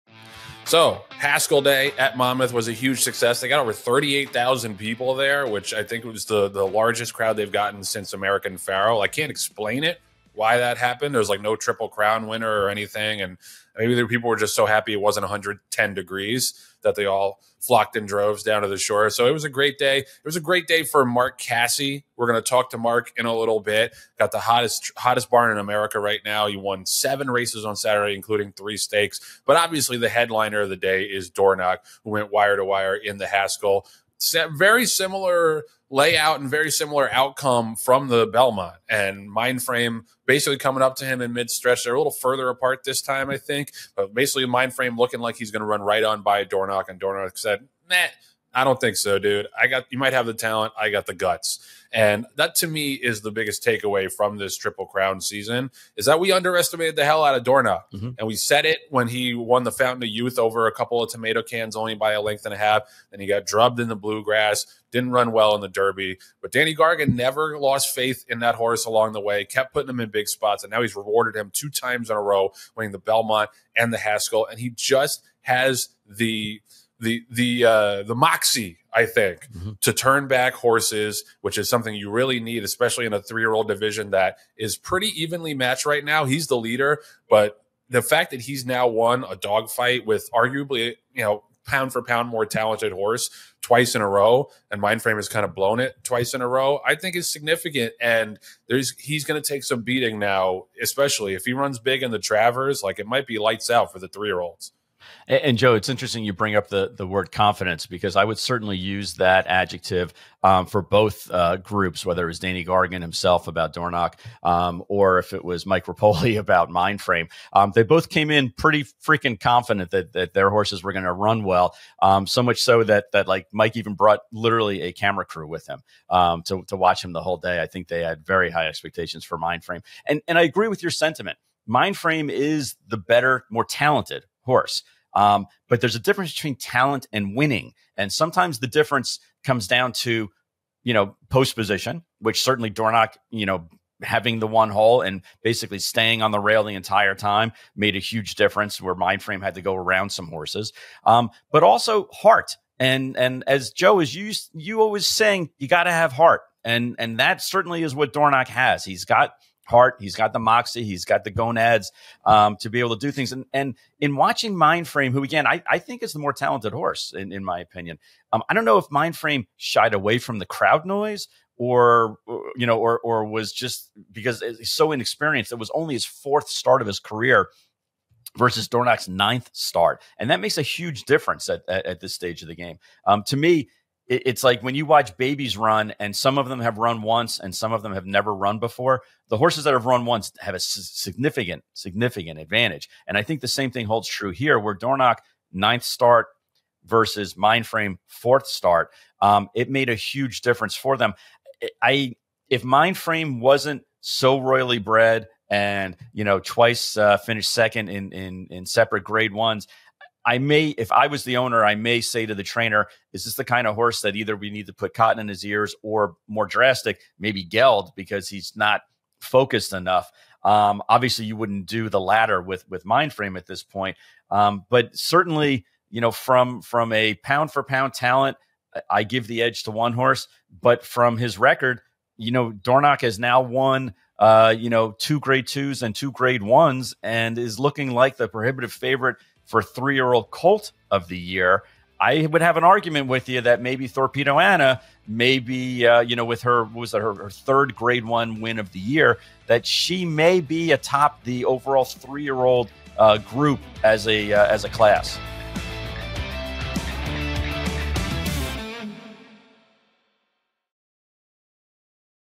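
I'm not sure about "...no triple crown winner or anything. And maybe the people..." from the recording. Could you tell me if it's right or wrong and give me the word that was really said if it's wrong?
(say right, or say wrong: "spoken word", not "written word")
right.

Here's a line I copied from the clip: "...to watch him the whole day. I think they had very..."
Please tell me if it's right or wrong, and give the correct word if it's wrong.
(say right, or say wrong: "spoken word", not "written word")
right.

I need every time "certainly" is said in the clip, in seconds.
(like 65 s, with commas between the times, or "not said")
108 s, 142 s, 157 s, 224 s.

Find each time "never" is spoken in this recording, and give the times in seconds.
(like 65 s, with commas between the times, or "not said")
67 s, 188 s.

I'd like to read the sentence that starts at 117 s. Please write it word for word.
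Um, they both came in pretty freaking confident that that their horses were going to run well.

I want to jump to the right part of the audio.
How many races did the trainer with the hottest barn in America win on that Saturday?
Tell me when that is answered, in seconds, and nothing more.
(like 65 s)
26 s.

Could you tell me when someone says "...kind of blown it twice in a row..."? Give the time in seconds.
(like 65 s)
95 s.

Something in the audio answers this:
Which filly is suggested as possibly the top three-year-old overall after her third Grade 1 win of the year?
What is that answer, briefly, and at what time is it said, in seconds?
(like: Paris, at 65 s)
Thorpedo Anna, at 243 s.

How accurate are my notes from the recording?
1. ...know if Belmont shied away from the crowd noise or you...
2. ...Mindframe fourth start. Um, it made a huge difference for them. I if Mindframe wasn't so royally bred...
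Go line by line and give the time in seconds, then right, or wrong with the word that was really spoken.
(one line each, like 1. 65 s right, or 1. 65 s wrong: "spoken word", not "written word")
1. 168 s wrong: "Mindframe", not "Belmont"
2. 197 s right.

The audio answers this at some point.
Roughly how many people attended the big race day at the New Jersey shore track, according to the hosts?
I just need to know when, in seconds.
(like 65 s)
3 s.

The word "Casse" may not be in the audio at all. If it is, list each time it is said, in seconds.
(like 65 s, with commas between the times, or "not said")
21 s.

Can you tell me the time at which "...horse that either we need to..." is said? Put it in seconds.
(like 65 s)
213 s.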